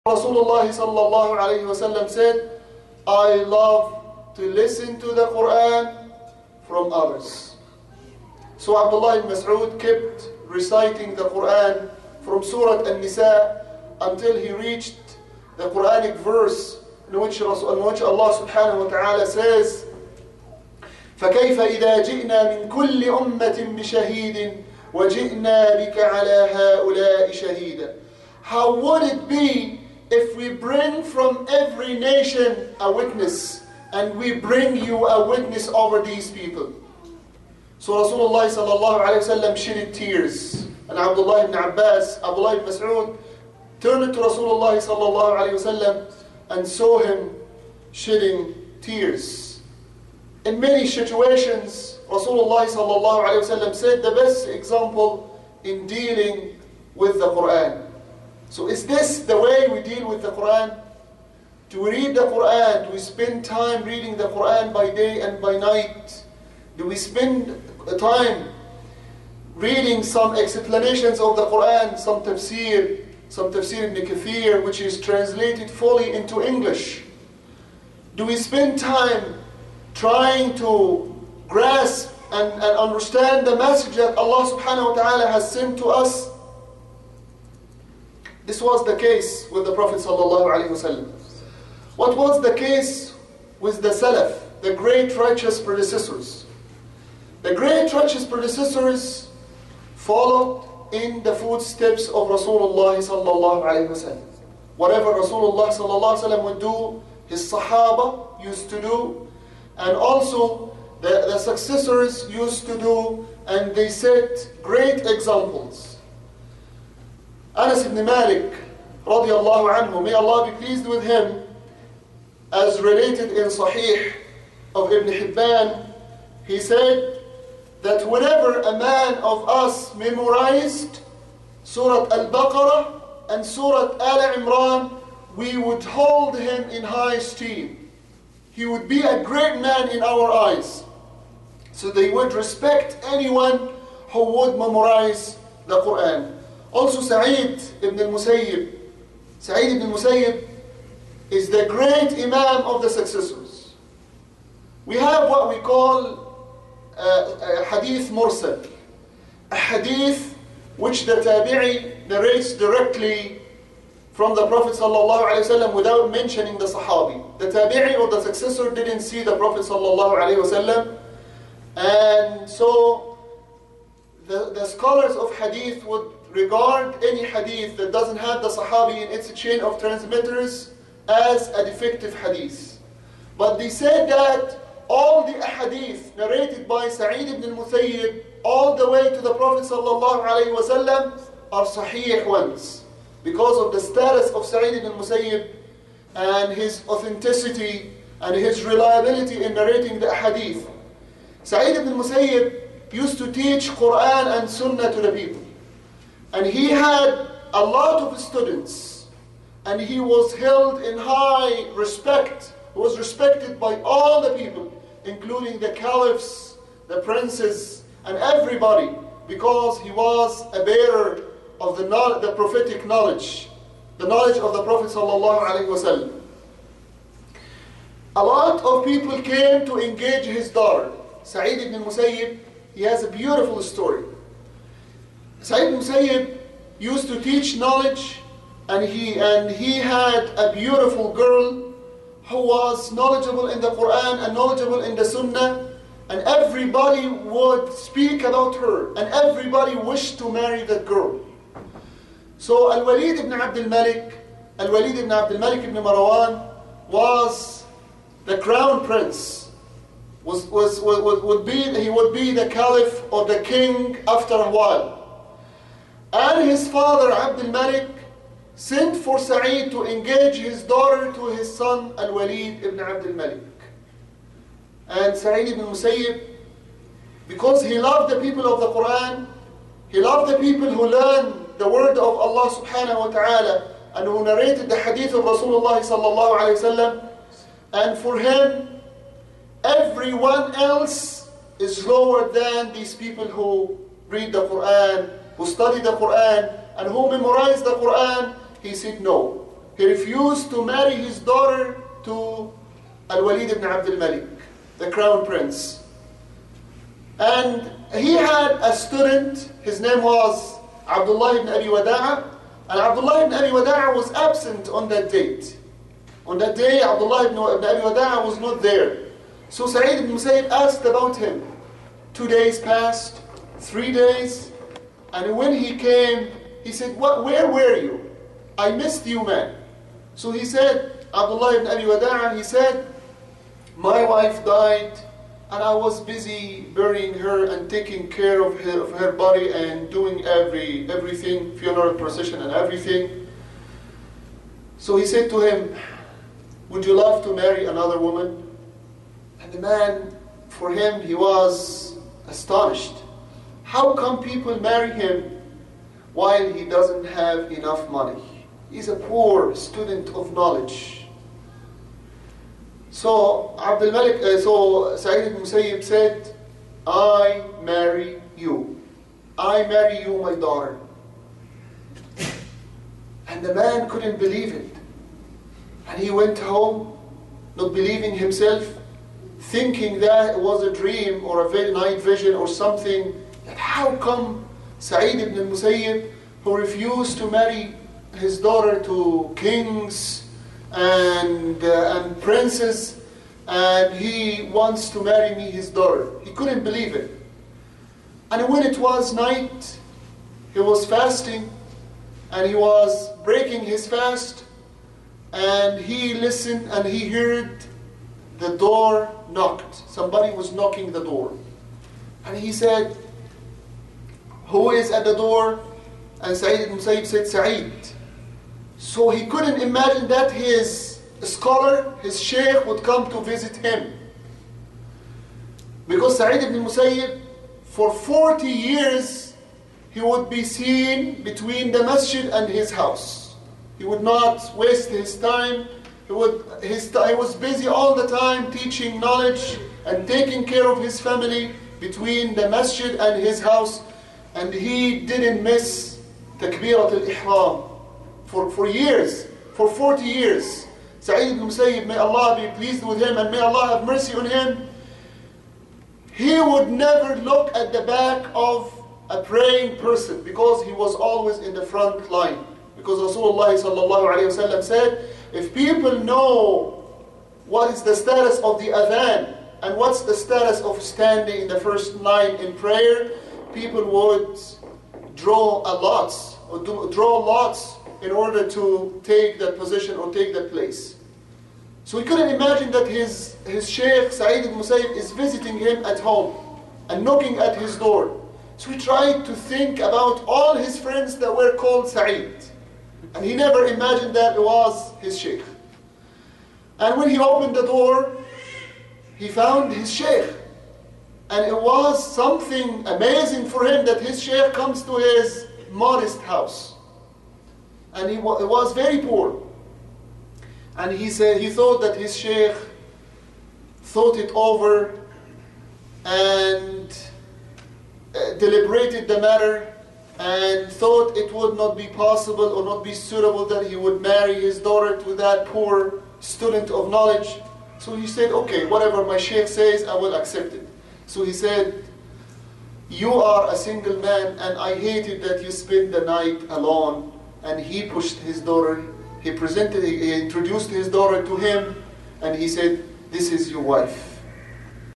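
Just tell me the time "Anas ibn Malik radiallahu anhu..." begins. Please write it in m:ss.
1:57.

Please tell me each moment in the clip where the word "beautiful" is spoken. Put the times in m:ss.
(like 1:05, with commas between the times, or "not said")
3:53, 4:00.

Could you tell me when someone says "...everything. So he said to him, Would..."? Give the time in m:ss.
5:42.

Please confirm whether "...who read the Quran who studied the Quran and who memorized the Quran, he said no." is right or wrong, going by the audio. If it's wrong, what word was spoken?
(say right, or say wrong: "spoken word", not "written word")
right.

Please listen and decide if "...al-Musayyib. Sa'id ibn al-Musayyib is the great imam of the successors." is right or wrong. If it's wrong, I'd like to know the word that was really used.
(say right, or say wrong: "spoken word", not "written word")
right.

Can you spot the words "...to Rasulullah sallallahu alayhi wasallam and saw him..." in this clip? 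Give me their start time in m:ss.
0:44.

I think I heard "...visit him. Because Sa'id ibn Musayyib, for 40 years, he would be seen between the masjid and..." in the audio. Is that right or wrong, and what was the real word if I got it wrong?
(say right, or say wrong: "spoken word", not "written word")
right.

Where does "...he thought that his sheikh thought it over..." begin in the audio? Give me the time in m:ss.
8:31.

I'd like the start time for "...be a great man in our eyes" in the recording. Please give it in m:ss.
2:18.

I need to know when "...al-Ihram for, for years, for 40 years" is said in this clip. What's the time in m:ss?
7:26.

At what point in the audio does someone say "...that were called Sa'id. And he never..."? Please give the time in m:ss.
8:11.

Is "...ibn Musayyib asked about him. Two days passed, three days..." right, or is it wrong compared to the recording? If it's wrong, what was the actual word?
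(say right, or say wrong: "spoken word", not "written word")
right.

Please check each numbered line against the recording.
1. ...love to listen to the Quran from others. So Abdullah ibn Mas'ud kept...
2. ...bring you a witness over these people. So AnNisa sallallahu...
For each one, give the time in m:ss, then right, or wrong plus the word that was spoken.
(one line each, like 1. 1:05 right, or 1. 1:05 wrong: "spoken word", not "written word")
1. 0:03 right
2. 0:34 wrong: "Rasulullah", not "AnNisa".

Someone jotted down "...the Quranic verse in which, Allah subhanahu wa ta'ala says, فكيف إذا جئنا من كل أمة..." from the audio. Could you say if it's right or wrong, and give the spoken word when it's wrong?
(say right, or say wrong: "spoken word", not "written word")
right.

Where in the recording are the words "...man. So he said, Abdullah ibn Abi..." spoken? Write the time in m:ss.
5:29.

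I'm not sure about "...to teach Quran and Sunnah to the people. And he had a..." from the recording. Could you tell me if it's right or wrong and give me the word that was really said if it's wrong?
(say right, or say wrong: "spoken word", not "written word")
right.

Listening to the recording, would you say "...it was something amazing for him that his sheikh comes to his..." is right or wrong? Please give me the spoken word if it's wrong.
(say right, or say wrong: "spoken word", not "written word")
right.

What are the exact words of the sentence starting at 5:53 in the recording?
How come people marry him while he doesn't have enough money?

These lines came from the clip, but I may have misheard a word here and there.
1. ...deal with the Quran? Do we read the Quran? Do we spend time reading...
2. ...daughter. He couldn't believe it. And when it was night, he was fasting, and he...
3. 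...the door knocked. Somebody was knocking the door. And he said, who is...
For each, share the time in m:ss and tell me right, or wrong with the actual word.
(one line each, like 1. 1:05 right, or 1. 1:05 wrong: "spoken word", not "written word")
1. 0:59 right
2. 6:35 right
3. 6:48 right.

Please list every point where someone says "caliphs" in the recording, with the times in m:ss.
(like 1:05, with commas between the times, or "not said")
3:35, 4:22.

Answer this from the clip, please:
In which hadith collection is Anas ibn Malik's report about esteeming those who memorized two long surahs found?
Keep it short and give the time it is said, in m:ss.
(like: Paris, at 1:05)
Sahih of Ibn Hibban, at 2:03.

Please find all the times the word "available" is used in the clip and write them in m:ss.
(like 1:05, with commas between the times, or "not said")
not said.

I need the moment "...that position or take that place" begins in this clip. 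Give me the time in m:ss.
7:59.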